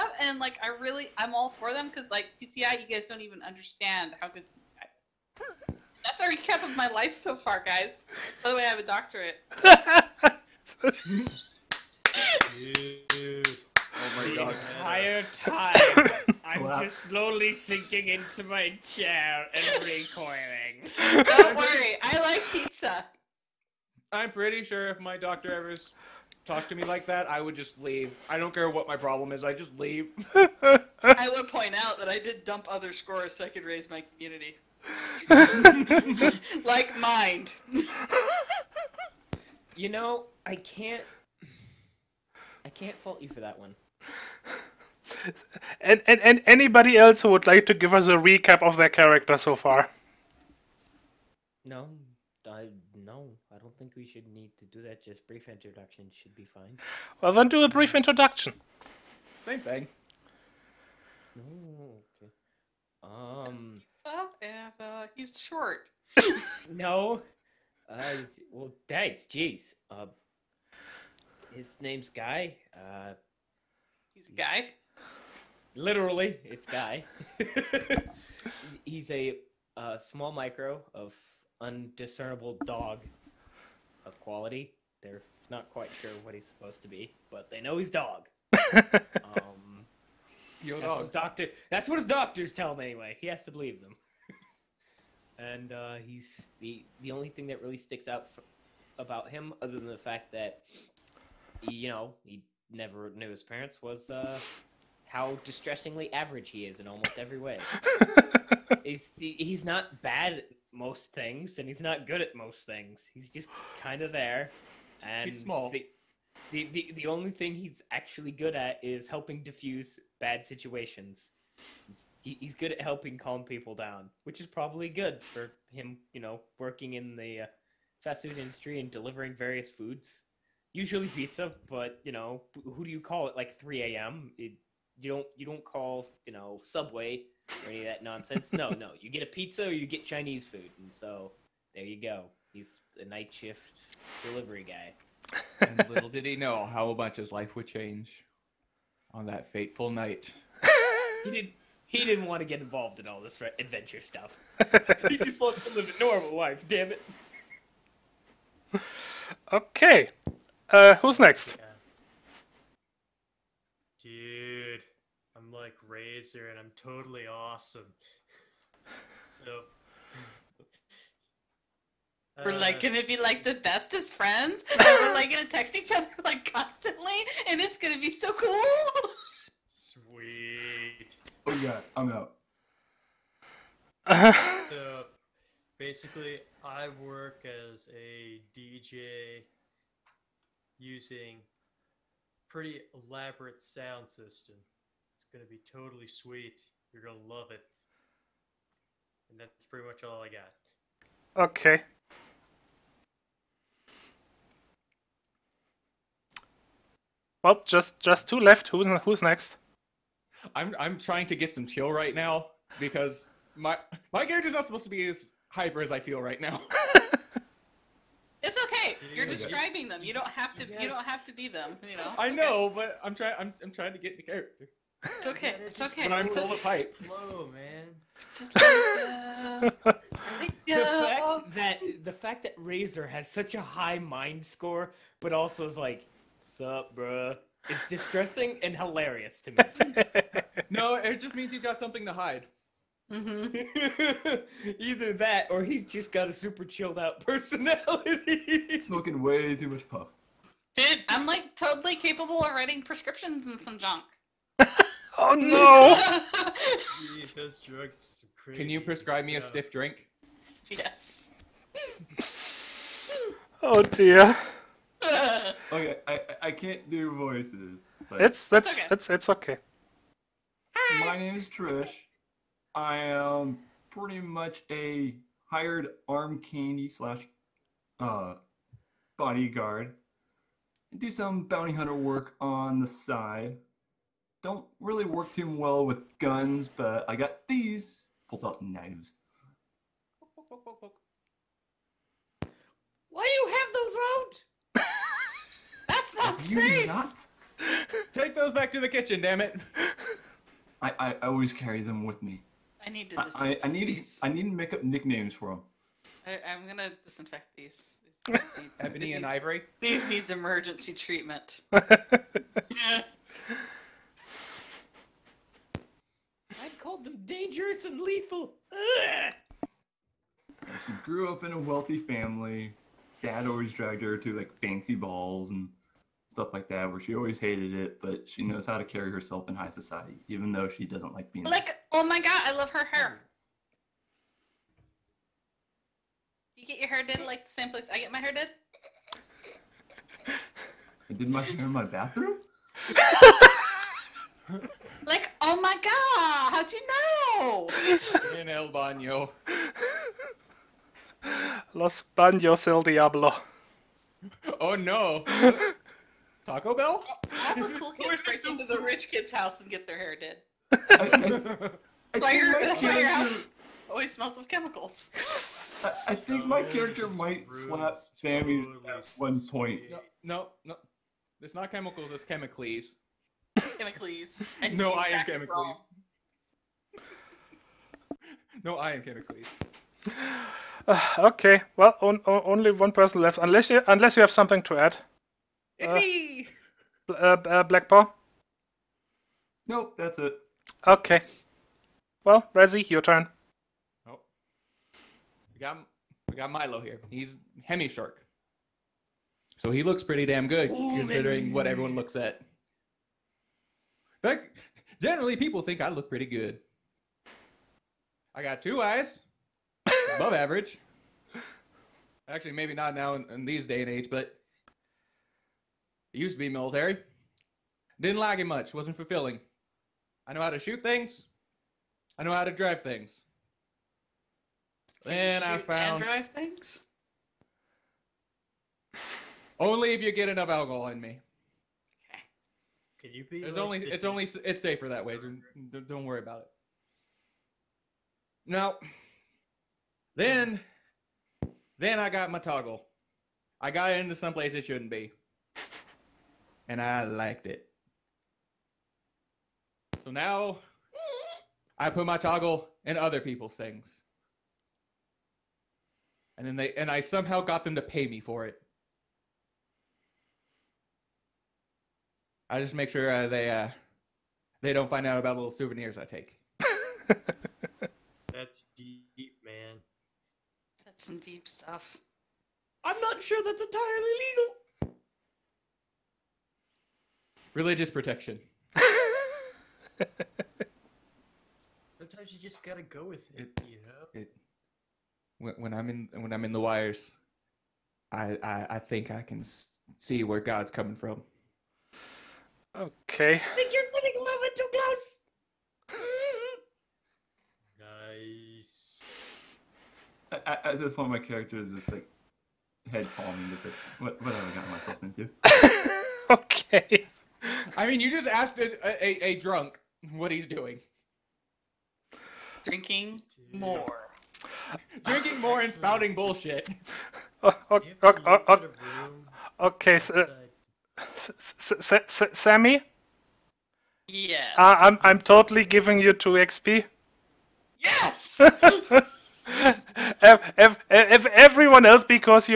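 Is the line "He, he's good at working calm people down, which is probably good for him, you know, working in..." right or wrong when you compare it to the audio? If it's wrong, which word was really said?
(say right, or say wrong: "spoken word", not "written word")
wrong: "helping", not "working".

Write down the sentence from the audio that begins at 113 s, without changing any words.
He's just kind of there, and he's small.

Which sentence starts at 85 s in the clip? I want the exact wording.
They're not quite sure what he's supposed to be, but they know he's dog.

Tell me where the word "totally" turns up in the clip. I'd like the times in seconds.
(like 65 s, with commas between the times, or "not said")
166 s, 195 s, 251 s, 525 s.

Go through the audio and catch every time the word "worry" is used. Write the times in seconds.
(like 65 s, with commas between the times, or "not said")
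21 s, 436 s.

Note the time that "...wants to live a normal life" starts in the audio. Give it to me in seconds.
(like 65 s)
155 s.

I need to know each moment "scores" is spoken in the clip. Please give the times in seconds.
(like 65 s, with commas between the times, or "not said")
32 s, 234 s.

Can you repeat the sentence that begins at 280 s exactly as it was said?
I do some bounty hunter work on the side.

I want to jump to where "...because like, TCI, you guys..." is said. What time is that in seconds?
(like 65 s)
1 s.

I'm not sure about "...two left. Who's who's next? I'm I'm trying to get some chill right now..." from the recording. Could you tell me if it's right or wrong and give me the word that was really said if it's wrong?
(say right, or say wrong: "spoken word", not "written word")
right.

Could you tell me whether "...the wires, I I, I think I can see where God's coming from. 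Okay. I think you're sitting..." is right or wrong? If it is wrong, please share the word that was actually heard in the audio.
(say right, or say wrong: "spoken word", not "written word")
right.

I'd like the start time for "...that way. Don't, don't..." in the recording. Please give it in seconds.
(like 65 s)
434 s.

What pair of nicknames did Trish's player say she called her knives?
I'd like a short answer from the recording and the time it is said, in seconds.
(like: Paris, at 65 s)
Dangerous and lethal, at 317 s.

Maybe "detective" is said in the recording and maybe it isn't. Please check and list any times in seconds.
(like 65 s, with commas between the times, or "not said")
not said.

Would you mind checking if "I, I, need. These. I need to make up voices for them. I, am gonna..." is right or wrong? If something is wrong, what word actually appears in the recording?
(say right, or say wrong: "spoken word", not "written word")
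wrong: "nicknames", not "voices".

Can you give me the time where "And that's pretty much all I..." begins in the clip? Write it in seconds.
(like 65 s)
199 s.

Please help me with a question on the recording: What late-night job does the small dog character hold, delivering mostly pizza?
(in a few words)
Night shift delivery guy.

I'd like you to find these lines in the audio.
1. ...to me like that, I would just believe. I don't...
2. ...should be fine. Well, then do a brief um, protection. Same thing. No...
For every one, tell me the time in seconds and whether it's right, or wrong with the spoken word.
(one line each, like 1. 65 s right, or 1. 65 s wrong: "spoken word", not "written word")
1. 26 s wrong: "leave", not "believe"
2. 56 s wrong: "introduction", not "protection".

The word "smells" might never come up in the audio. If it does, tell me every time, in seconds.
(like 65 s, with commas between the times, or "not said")
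364 s.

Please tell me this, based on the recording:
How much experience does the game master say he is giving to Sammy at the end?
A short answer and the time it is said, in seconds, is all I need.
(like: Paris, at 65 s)
2 XP, at 526 s.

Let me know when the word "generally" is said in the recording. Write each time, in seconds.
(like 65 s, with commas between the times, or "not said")
405 s.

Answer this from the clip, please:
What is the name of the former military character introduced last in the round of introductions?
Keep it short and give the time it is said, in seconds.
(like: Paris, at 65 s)
Milo, at 396 s.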